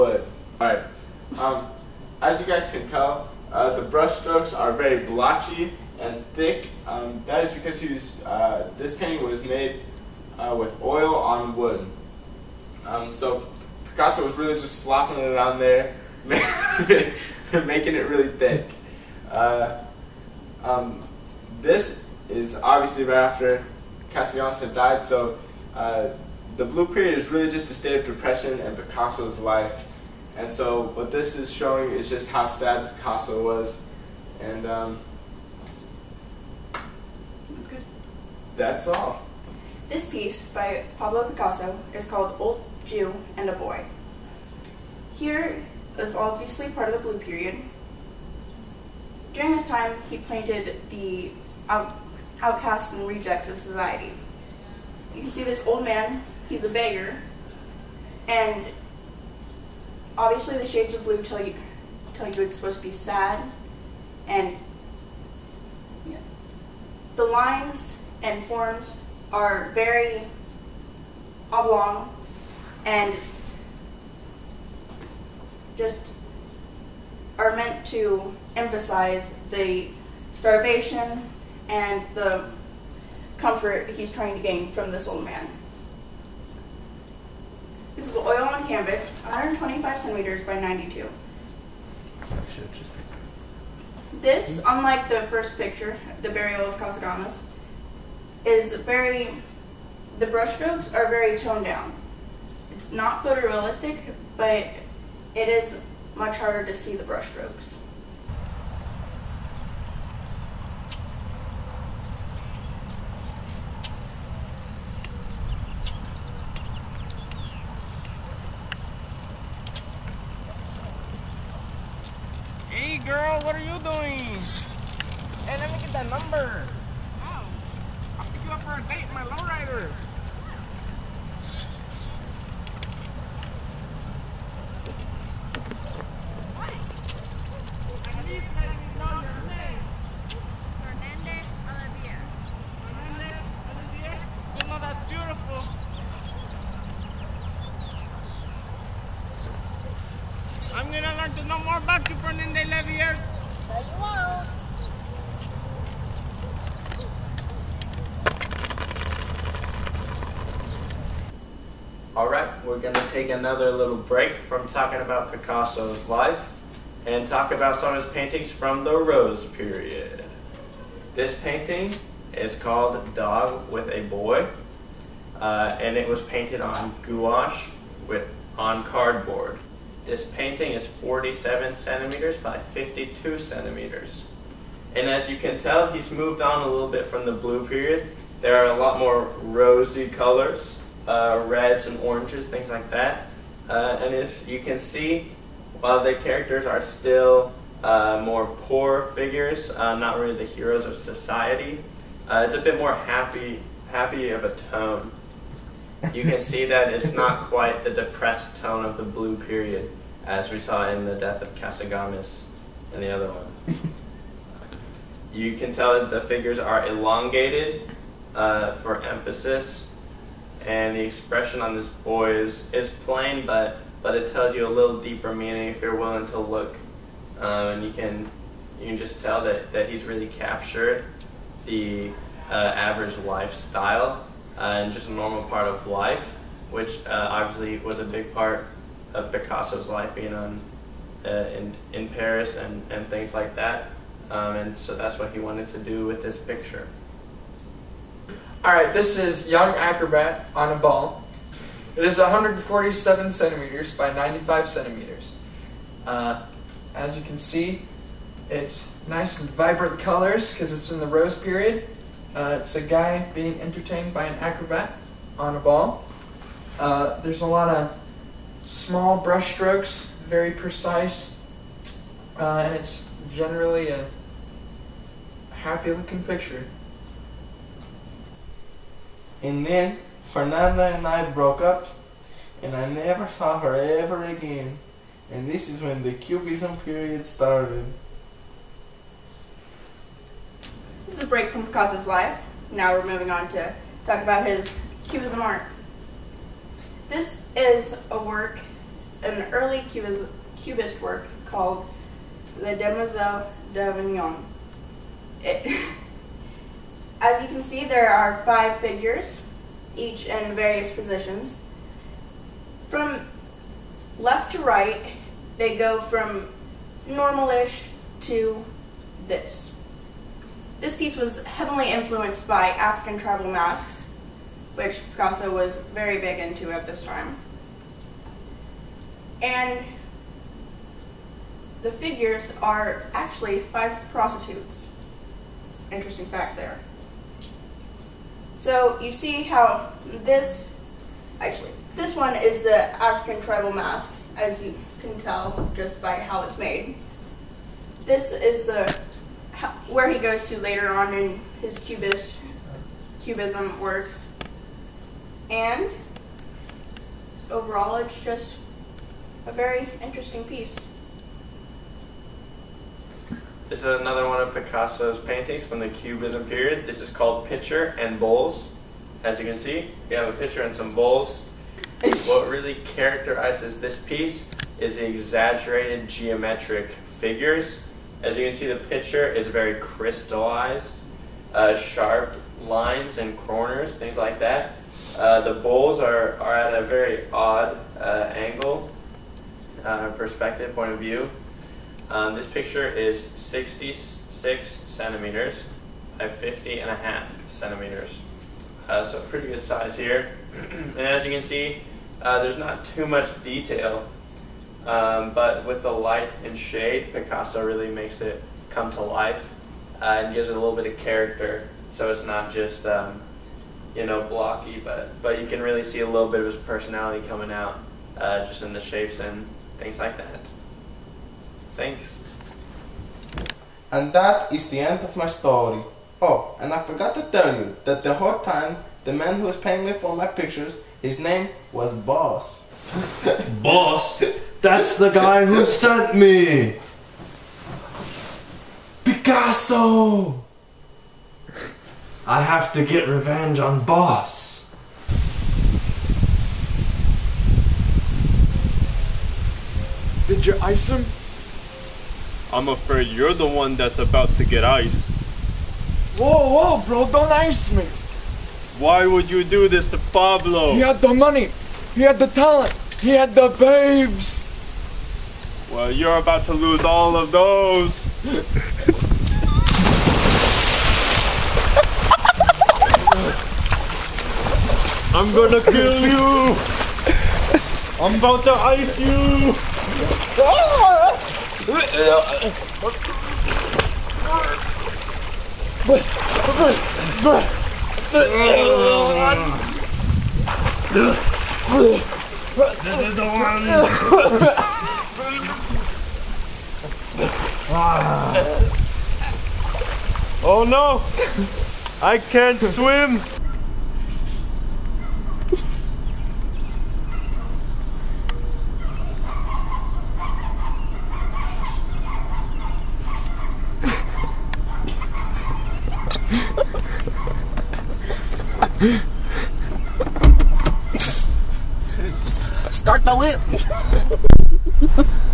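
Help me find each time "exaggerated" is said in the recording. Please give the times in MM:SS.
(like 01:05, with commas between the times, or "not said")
06:15.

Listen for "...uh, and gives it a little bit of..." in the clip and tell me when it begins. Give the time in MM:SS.
06:50.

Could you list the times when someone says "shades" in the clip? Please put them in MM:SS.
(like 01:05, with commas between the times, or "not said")
01:00, 06:46.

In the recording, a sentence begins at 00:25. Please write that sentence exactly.
So uh, the blue period is really just a state of depression in Picasso's life.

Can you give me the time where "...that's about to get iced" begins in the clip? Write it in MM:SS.
07:33.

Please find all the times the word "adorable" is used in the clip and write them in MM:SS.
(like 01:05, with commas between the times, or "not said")
not said.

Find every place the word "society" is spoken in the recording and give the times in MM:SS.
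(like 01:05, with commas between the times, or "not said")
00:53, 03:20.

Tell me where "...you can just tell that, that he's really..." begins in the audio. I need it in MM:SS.
03:48.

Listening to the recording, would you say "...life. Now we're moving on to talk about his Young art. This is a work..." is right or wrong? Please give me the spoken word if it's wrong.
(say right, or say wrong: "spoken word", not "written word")
wrong: "Cubism", not "Young".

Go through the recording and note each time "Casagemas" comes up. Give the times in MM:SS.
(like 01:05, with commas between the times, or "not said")
01:36, 03:31.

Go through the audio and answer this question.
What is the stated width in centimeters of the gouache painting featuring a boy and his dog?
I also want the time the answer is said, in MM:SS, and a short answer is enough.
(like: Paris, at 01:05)
52, at 03:02.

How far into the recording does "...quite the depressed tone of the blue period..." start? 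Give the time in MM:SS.
03:27.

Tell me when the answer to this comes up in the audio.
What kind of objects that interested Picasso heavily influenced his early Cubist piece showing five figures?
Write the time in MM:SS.
05:22.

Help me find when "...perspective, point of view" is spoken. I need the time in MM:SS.
06:30.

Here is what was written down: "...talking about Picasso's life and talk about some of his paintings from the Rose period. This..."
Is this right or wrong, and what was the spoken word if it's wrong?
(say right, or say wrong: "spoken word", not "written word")
right.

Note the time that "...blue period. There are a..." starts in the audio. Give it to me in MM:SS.
03:07.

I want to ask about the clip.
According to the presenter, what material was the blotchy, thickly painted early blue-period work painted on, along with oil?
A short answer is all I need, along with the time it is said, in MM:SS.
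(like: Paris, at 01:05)
wood, at 00:10.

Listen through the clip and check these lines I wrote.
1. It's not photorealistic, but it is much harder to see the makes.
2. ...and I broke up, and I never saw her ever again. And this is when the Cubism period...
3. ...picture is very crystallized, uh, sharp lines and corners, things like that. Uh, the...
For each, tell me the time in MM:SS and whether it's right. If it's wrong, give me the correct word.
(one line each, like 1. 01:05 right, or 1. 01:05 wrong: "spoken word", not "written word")
1. 01:42 wrong: "brushstrokes", not "makes"
2. 04:40 right
3. 06:18 right.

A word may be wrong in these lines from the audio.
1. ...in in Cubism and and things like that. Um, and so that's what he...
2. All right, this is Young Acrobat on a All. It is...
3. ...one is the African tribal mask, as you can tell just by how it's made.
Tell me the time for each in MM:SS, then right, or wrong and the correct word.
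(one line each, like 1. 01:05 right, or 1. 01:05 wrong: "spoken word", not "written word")
1. 04:01 wrong: "Paris", not "Cubism"
2. 04:08 wrong: "Ball", not "All"
3. 05:42 right.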